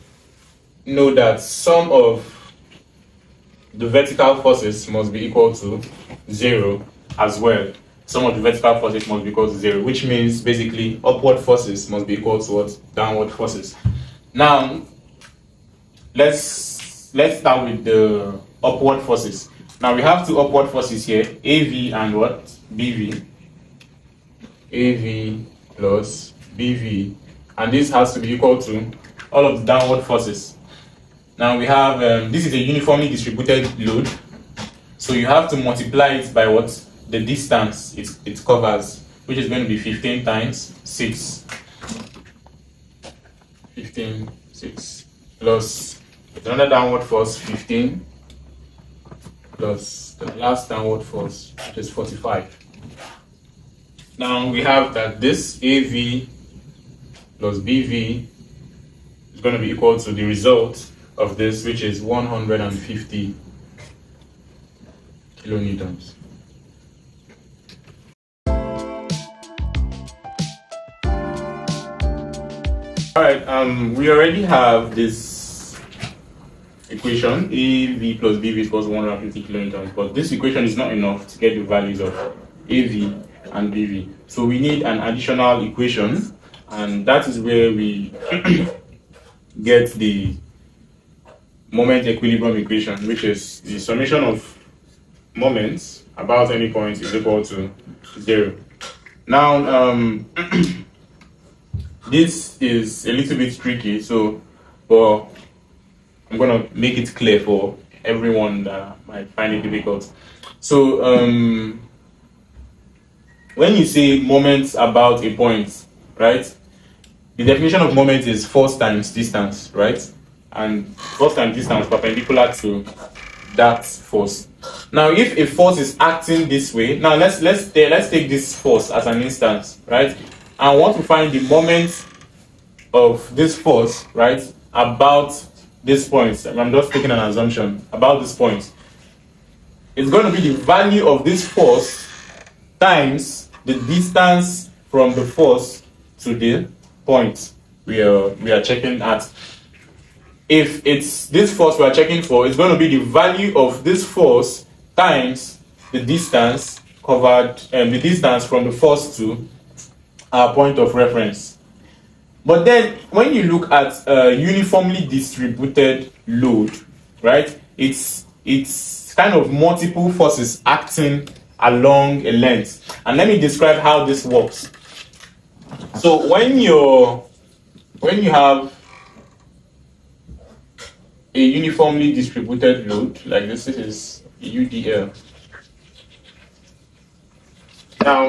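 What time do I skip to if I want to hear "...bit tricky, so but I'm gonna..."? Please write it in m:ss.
1:43.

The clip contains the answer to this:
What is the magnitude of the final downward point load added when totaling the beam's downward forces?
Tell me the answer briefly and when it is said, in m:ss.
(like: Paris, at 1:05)
45, at 0:51.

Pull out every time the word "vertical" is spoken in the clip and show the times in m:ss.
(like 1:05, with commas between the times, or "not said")
0:03, 0:08.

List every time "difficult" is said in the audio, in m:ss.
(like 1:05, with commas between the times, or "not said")
1:49.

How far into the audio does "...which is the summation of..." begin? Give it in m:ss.
1:33.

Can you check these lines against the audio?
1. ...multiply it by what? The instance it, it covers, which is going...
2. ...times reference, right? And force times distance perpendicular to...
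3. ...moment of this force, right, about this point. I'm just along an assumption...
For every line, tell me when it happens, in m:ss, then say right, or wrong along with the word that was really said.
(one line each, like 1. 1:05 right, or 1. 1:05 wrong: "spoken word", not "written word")
1. 0:35 wrong: "distance", not "instance"
2. 1:58 wrong: "distance", not "reference"
3. 2:11 wrong: "taking", not "along".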